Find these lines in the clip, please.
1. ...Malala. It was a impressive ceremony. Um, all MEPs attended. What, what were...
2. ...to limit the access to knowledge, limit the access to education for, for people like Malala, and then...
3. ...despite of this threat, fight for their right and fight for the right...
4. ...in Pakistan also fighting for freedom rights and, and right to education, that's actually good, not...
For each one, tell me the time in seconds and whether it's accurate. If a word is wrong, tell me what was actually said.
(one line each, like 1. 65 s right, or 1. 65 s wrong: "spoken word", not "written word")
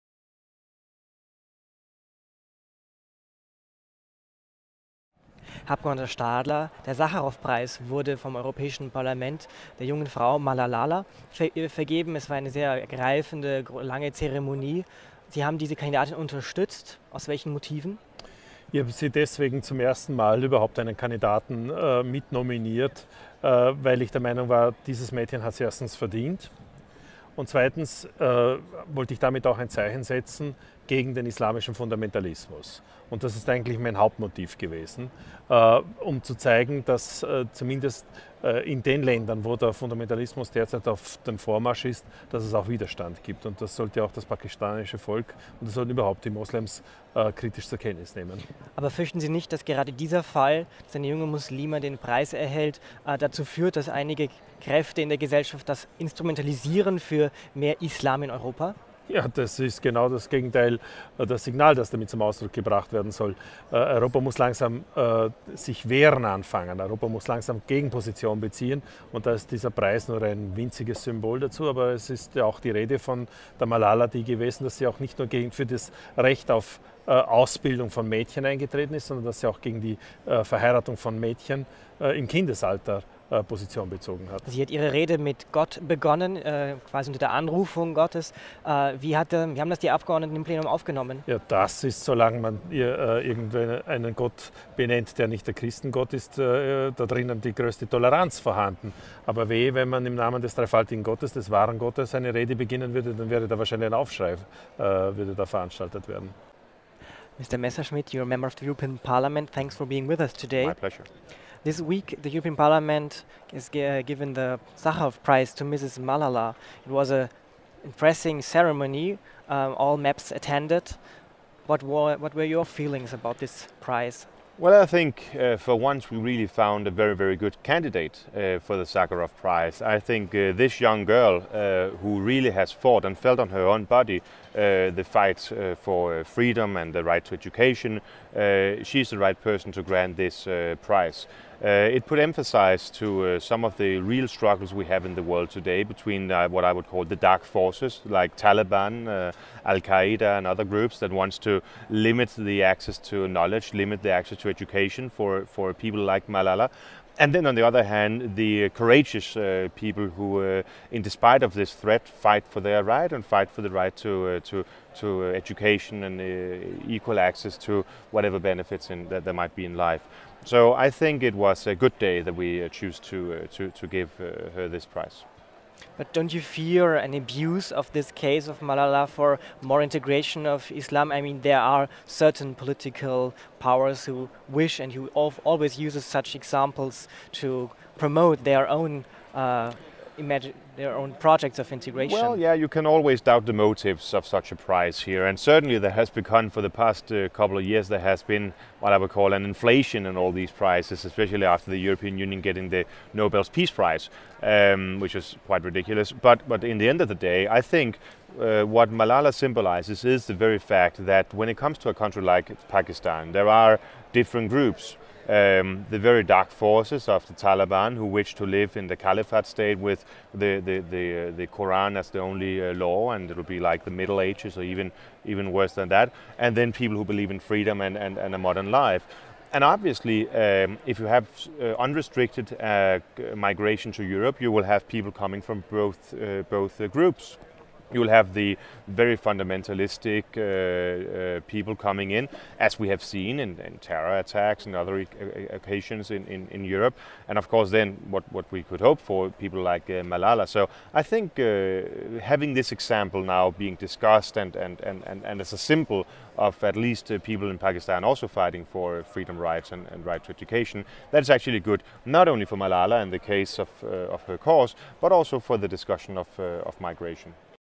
1. 115 s right
2. 151 s right
3. 161 s right
4. 257 s right.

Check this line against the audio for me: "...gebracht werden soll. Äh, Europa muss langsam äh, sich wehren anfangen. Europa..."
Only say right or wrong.
right.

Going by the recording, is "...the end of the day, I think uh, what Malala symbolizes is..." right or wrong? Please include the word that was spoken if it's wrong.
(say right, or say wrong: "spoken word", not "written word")
right.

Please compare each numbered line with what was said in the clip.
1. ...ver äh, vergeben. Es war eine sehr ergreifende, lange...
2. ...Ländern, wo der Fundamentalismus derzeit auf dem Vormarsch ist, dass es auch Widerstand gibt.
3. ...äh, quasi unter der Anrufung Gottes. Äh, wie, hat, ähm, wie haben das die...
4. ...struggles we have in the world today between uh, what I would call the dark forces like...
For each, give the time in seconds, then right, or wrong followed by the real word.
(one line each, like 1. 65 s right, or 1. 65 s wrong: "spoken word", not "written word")
1. 11 s right
2. 39 s right
3. 86 s right
4. 144 s right.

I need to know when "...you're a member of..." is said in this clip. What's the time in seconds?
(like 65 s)
108 s.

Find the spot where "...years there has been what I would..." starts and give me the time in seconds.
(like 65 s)
197 s.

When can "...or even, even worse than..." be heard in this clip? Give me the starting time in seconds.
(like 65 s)
224 s.